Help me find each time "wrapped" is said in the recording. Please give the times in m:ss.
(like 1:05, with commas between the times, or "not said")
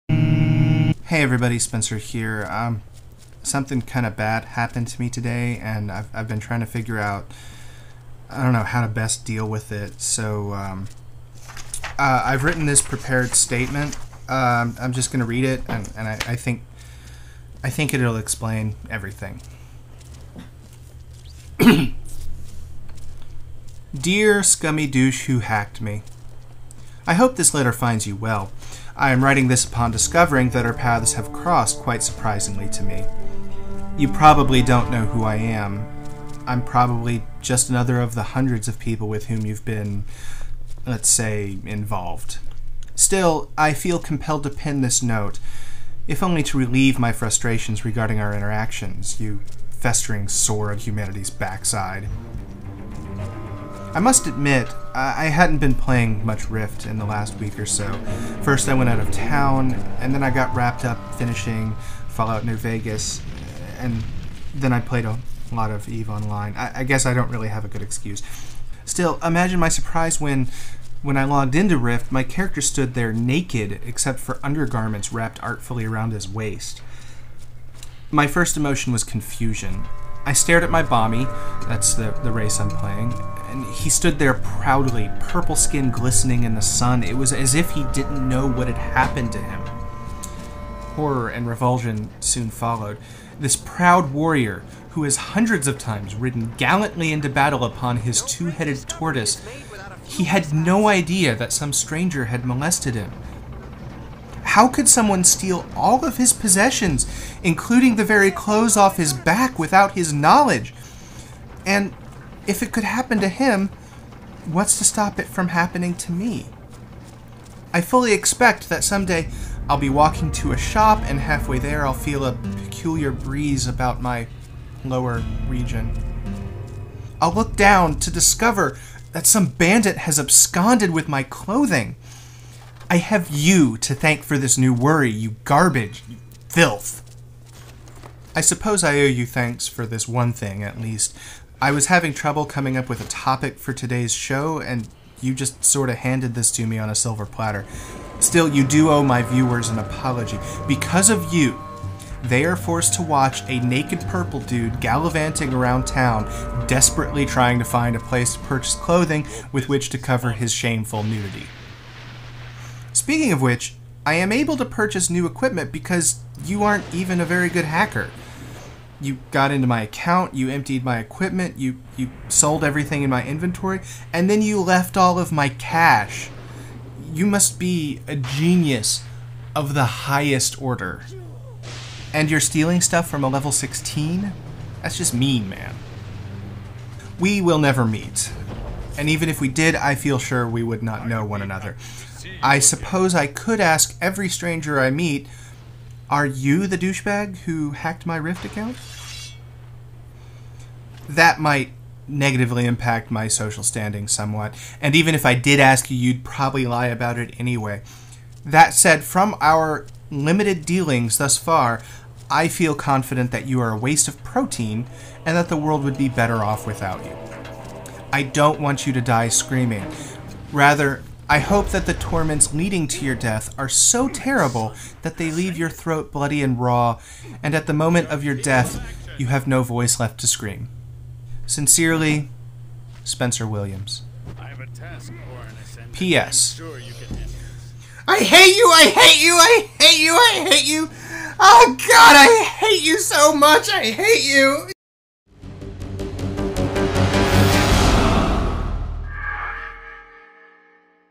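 1:00, 1:15.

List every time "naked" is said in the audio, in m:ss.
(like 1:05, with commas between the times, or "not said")
1:13, 2:33.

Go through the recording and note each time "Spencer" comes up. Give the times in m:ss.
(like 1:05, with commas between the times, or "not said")
0:01, 3:53.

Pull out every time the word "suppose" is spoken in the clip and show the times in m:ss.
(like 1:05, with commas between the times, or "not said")
2:18, 3:12.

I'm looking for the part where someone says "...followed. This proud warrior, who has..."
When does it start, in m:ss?
1:32.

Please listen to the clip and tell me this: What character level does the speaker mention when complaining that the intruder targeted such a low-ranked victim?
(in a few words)
16.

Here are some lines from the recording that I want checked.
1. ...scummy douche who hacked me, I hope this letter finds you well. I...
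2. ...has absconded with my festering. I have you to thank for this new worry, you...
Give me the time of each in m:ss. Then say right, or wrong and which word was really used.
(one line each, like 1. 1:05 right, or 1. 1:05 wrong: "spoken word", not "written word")
1. 0:24 right
2. 2:09 wrong: "clothing", not "festering".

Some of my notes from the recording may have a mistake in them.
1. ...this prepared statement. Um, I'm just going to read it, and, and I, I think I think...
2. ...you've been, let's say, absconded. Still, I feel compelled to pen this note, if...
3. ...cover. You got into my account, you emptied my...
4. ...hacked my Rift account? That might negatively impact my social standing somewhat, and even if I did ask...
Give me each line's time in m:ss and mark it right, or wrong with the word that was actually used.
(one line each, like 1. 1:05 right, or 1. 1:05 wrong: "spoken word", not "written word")
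1. 0:12 right
2. 0:39 wrong: "involved", not "absconded"
3. 2:47 wrong: "hacker", not "cover"
4. 3:17 right.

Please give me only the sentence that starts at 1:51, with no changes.
And if it could happen to him, what's to stop it from happening to me?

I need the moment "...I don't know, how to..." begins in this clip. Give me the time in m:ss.
0:08.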